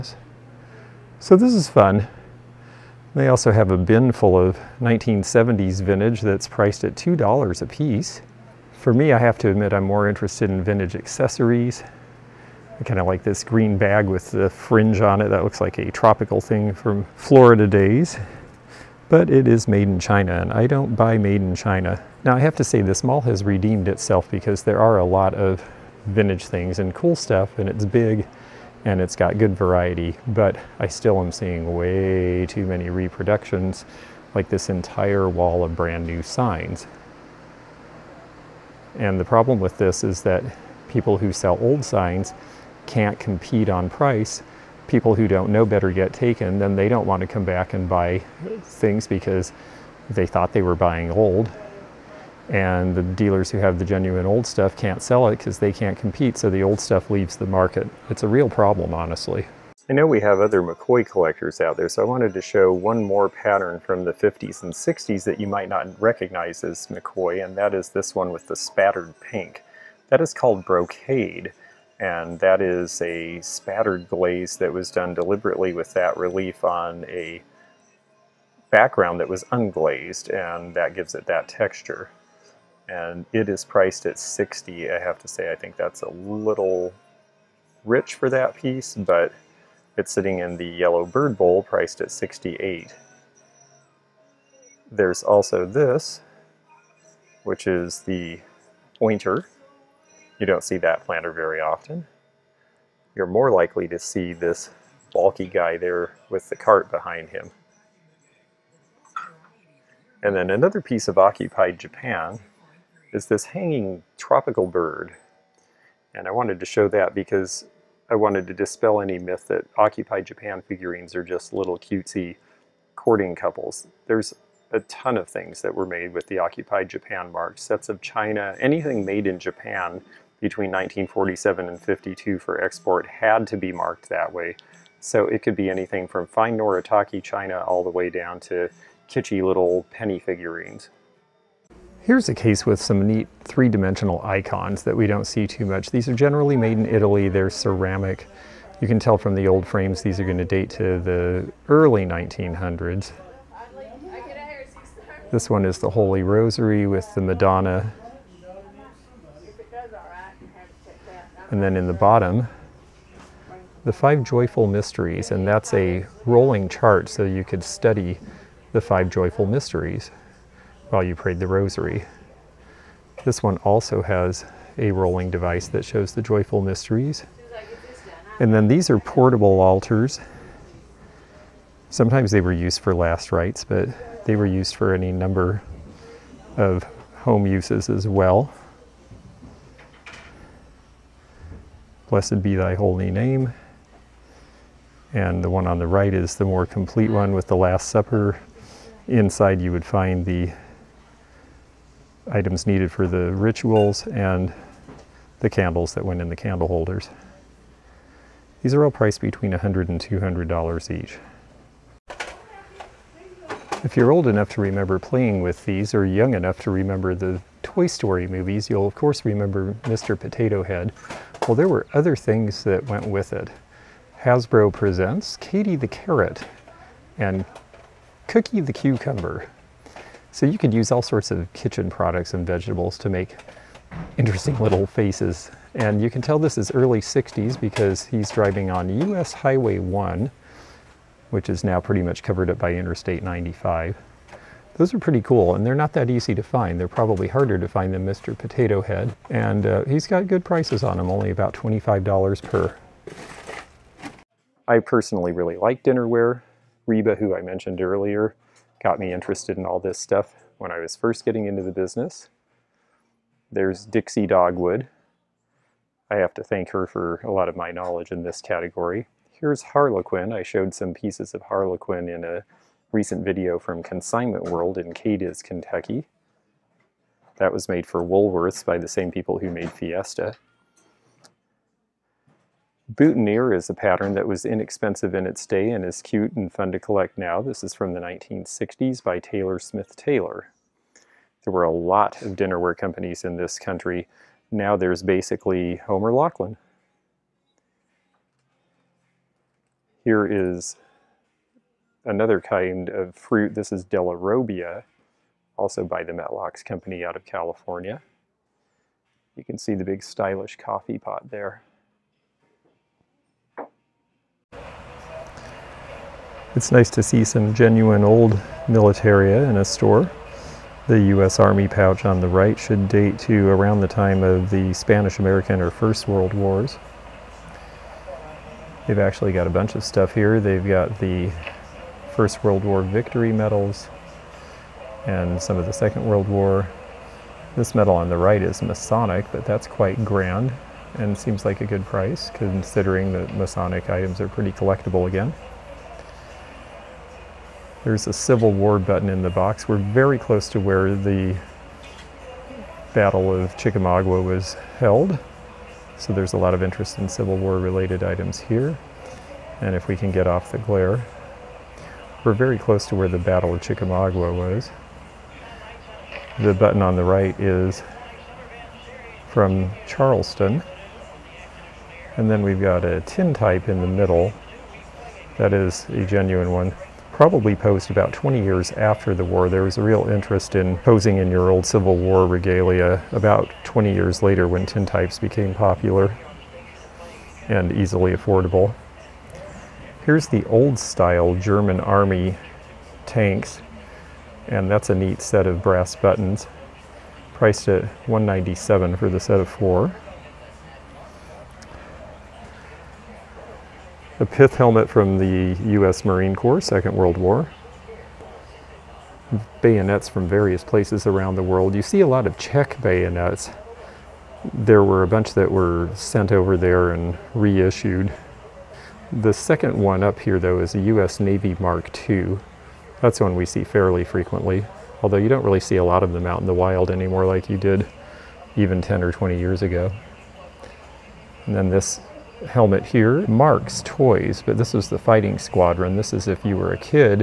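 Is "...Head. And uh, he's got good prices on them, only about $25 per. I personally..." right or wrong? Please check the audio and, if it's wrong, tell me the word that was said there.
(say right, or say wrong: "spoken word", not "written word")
right.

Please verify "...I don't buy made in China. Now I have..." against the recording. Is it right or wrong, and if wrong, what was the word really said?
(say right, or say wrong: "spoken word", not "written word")
right.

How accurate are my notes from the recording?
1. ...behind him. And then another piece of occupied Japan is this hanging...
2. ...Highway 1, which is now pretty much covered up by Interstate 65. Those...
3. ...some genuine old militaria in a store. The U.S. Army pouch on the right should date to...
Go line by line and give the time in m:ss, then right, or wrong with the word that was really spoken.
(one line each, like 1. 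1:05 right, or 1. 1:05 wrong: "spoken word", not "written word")
1. 1:46 right
2. 3:59 wrong: "95", not "65"
3. 5:17 right.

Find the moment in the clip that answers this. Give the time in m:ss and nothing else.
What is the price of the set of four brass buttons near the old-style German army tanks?
6:38.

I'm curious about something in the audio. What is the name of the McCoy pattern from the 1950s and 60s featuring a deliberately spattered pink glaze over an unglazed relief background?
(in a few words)
Brocade.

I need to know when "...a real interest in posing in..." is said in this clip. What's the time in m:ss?
6:19.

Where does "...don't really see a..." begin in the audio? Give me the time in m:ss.
7:05.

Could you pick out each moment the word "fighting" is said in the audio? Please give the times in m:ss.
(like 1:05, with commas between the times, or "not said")
7:14.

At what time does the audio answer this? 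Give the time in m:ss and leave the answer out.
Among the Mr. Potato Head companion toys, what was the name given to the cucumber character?
3:48.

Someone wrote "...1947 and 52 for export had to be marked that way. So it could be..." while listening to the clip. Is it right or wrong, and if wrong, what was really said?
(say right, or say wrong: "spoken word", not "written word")
right.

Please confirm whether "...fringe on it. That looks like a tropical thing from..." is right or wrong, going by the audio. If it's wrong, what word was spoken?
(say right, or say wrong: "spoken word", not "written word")
right.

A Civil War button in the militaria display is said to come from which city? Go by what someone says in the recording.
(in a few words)
Charleston.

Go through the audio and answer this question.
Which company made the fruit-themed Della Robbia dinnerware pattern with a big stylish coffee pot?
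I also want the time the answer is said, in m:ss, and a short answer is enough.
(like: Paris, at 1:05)
Metlox, at 5:06.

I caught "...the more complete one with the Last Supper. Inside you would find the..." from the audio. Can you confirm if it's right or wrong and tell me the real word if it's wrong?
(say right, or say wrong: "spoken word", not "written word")
right.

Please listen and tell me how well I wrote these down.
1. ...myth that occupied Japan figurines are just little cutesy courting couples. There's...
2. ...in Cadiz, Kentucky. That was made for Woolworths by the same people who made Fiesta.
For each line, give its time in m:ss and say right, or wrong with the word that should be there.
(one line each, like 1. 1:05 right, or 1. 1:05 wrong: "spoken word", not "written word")
1. 1:59 right
2. 4:34 right.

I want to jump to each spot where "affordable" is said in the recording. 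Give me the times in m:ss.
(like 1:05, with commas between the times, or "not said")
6:28.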